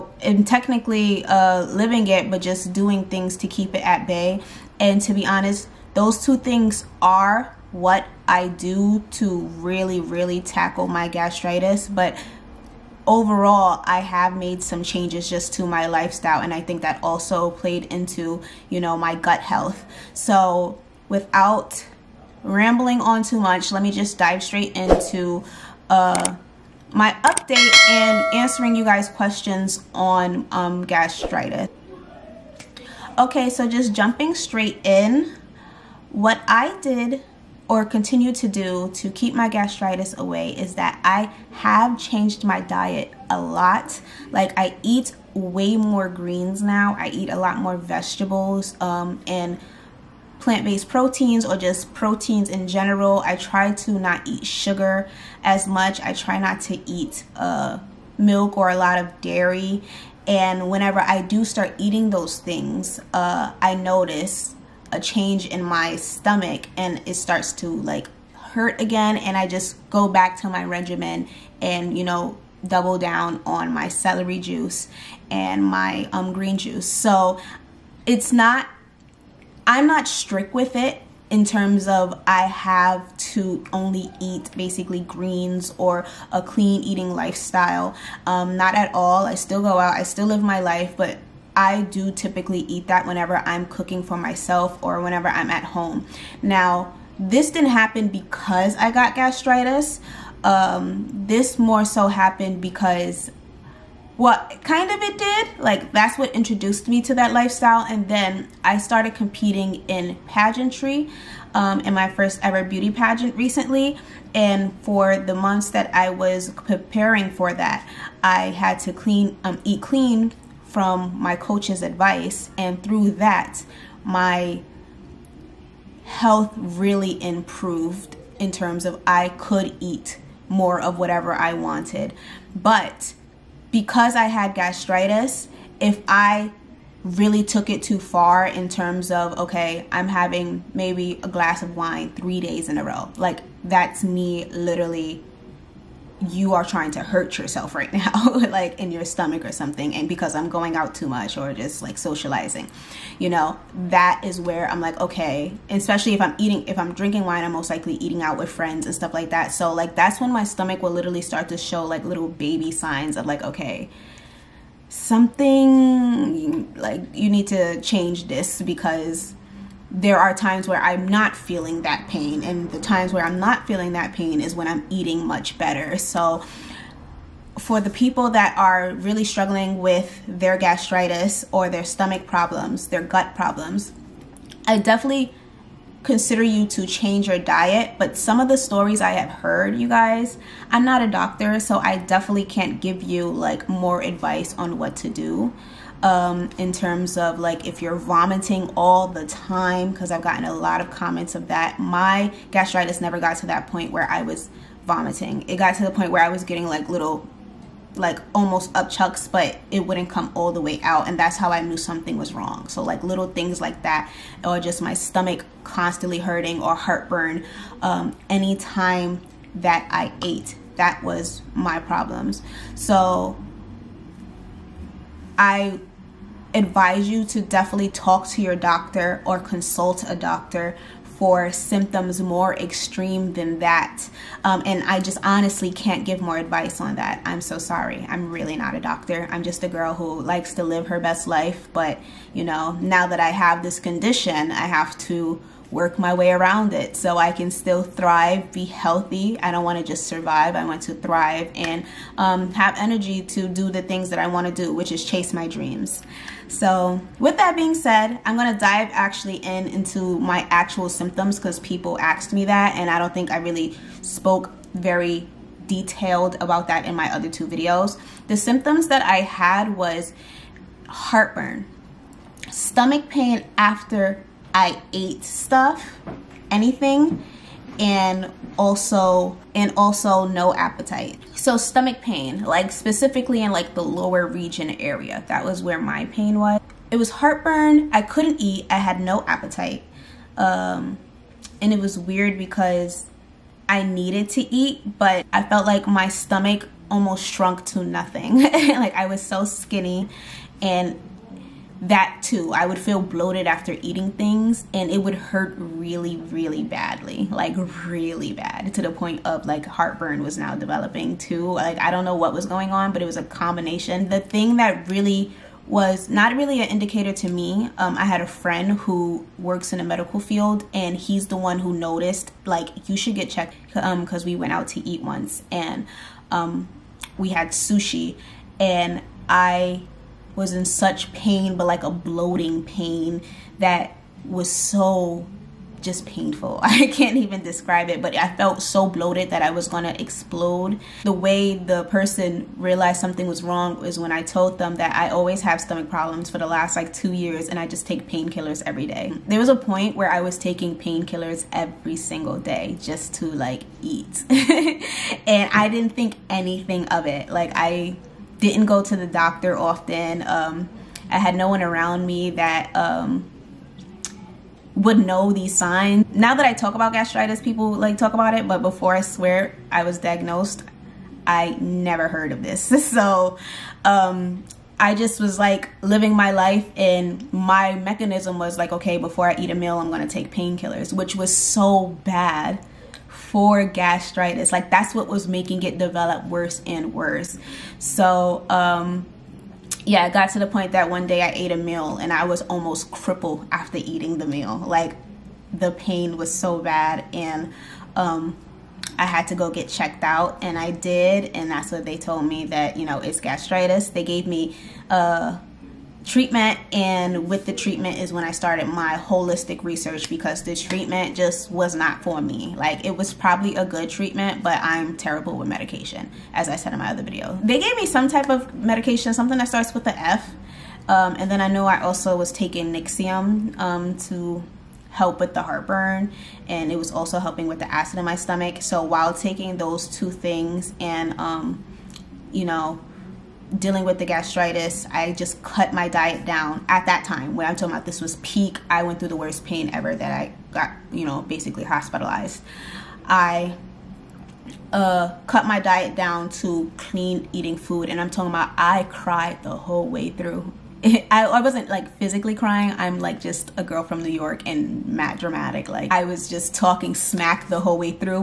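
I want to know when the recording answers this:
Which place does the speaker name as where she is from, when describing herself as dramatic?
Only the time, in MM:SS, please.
07:34.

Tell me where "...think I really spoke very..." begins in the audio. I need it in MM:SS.
04:23.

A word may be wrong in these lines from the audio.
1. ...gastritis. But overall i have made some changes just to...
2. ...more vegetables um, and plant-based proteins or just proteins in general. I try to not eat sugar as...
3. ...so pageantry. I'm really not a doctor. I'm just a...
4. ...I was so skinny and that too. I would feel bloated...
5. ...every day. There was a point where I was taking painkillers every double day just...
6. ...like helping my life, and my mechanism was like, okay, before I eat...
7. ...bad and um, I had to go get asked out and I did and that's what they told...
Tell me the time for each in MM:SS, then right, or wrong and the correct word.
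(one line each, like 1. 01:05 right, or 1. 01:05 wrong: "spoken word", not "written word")
1. 00:11 right
2. 00:47 right
3. 03:57 wrong: "sorry", not "pageantry"
4. 04:58 right
5. 05:48 wrong: "single", not "double"
6. 06:15 wrong: "living", not "helping"
7. 06:36 wrong: "checked", not "asked".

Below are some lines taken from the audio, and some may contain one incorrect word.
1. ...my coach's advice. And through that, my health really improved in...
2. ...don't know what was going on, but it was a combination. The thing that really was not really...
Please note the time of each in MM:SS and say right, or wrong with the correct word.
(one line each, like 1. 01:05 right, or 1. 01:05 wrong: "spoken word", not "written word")
1. 02:01 right
2. 05:11 right.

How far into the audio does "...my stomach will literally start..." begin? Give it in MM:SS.
02:40.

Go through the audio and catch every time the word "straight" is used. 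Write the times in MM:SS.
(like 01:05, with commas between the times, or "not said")
00:24, 00:34.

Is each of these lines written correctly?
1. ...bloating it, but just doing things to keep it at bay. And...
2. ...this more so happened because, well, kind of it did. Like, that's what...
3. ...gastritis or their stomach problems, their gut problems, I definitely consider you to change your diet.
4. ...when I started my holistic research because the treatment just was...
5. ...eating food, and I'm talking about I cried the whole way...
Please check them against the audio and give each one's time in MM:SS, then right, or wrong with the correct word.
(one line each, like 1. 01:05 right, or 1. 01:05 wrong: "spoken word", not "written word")
1. 00:01 wrong: "living", not "bloating"
2. 01:41 right
3. 03:00 right
4. 06:48 right
5. 07:27 right.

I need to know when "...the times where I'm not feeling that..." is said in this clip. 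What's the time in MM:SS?
02:52.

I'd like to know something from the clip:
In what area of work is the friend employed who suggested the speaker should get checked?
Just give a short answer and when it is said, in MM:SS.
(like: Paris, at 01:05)
Medical field, at 05:19.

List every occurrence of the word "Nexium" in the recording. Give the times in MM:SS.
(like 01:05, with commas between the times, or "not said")
07:02.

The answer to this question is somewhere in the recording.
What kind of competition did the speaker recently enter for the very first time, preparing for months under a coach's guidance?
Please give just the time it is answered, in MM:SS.
01:52.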